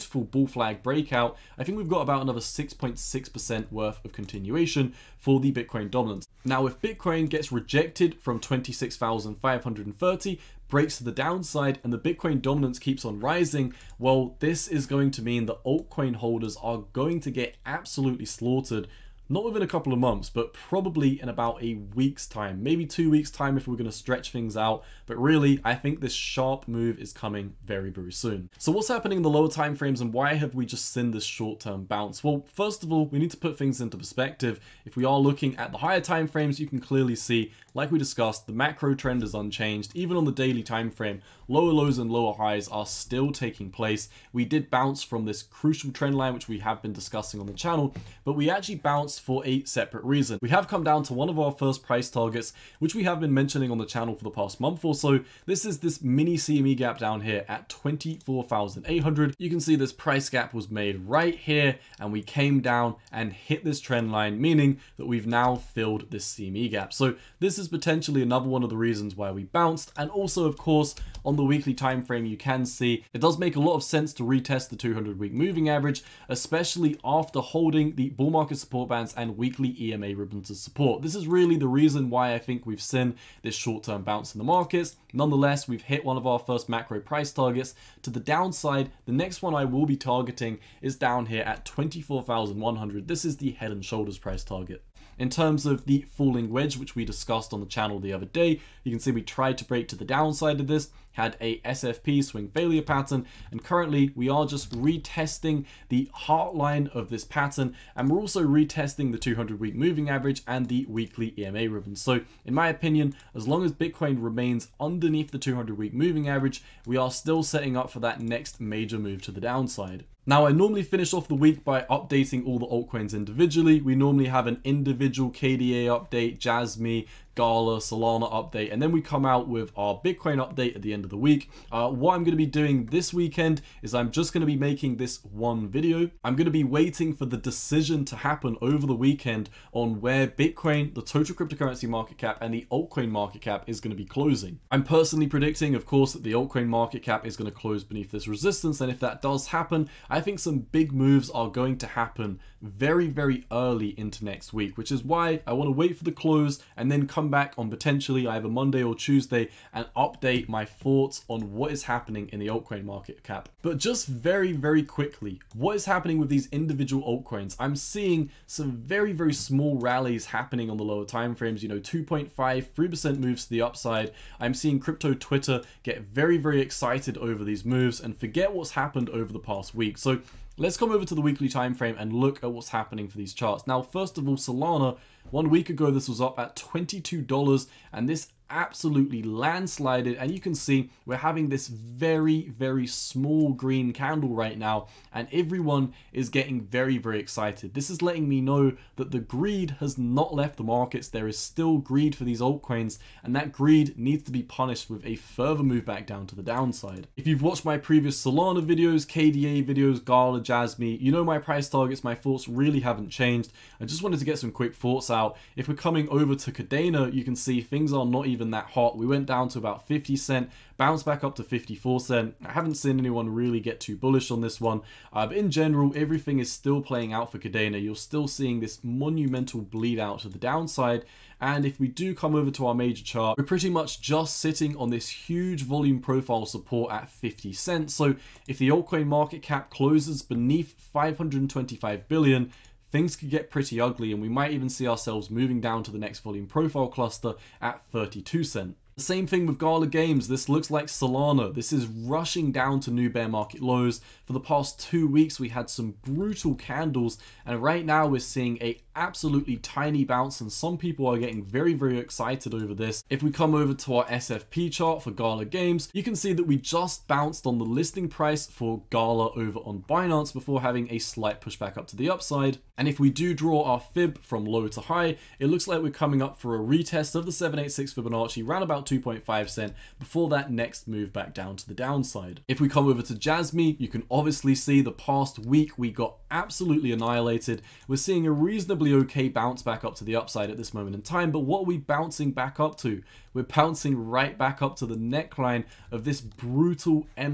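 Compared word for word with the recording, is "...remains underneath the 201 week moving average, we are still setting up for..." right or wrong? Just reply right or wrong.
wrong.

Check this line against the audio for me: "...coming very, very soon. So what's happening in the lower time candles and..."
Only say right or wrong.
wrong.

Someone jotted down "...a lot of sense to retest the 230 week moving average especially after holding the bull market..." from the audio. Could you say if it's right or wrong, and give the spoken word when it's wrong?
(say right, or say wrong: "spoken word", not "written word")
wrong: "200", not "230".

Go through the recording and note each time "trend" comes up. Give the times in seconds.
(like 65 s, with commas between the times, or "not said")
38 s, 45 s, 63 s.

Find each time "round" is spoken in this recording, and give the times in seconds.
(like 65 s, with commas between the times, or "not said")
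278 s.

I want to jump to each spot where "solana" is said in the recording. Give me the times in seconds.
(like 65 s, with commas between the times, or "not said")
127 s, 184 s, 208 s, 250 s.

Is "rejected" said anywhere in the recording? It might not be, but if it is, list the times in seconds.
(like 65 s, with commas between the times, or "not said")
7 s.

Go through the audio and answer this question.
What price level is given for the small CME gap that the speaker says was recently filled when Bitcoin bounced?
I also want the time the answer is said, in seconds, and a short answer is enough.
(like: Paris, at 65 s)
24,800, at 57 s.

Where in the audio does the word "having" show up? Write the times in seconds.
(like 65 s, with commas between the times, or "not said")
191 s, 270 s.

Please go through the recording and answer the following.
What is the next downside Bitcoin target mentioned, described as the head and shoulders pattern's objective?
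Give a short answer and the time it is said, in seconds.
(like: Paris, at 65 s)
24,100, at 91 s.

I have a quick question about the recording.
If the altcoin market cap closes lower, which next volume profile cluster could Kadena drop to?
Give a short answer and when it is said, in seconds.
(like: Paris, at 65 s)
32 cents, at 247 s.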